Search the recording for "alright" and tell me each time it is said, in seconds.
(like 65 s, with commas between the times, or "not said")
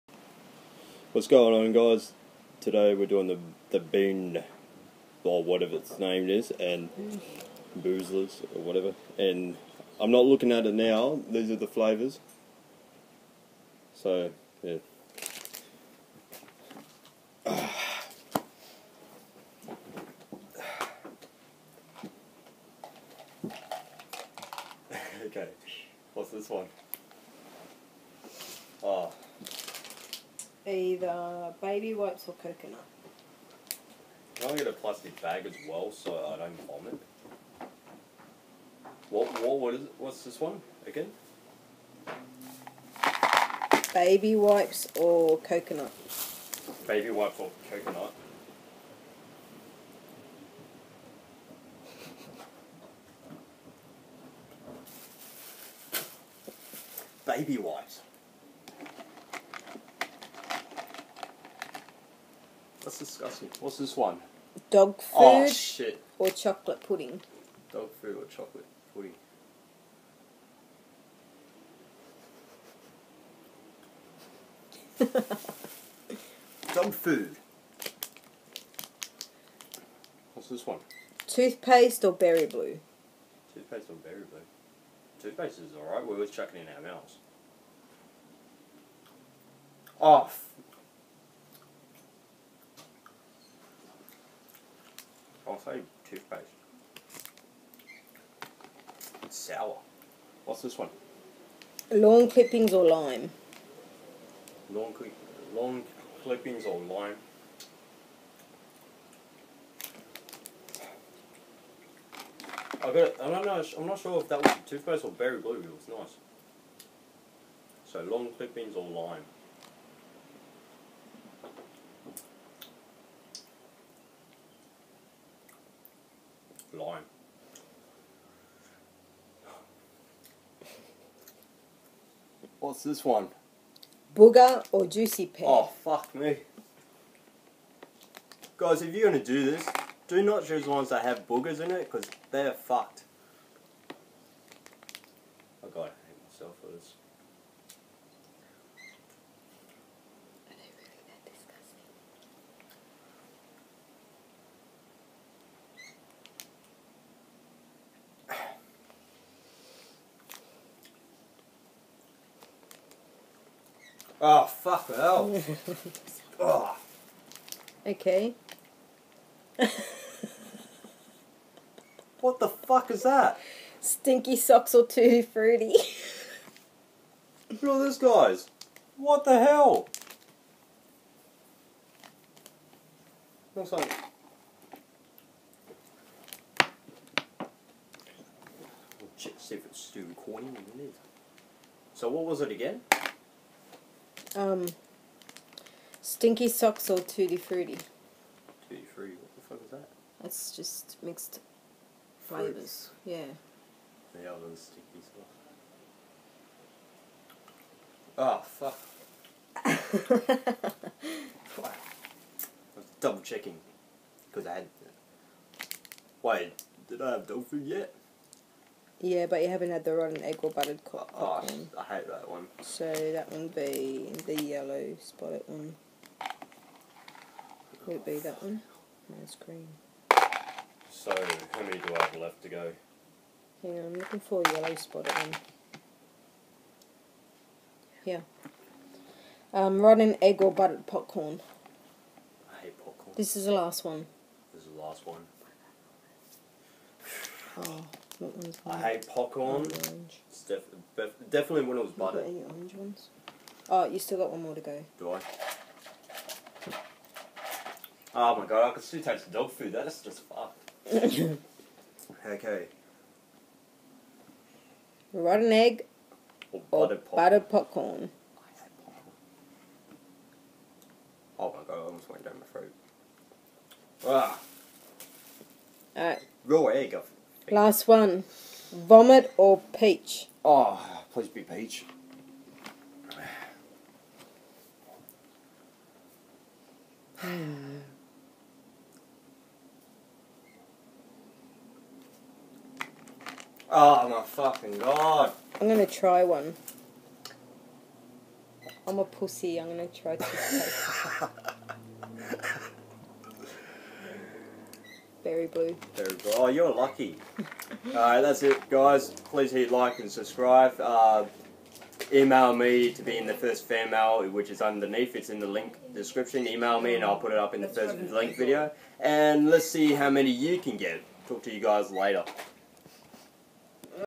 85 s, 275 s.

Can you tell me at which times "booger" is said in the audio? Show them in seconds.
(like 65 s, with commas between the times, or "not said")
134 s, 141 s.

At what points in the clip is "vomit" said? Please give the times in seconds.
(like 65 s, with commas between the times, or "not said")
36 s, 278 s.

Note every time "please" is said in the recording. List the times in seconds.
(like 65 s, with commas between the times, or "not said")
281 s, 309 s.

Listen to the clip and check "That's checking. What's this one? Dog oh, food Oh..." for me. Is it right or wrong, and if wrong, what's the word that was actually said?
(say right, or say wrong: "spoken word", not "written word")
wrong: "disgusting", not "checking".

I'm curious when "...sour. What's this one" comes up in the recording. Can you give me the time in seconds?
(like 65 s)
99 s.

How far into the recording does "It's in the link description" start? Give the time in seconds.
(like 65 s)
315 s.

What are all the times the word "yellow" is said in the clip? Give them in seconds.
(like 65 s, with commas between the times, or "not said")
224 s, 234 s.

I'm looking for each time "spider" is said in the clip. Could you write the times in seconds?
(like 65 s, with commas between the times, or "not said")
not said.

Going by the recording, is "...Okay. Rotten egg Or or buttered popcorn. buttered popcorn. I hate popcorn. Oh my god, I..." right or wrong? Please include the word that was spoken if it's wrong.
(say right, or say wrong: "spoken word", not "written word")
right.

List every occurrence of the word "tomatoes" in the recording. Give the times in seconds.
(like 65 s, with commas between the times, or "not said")
not said.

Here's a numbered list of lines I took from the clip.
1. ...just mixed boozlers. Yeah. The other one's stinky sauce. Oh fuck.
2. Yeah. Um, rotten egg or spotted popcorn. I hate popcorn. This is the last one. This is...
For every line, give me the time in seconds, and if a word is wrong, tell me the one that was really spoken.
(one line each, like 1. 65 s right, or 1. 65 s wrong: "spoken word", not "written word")
1. 200 s wrong: "flavors", not "boozlers"
2. 238 s wrong: "buttered", not "spotted".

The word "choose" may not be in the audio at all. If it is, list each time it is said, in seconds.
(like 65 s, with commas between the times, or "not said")
140 s.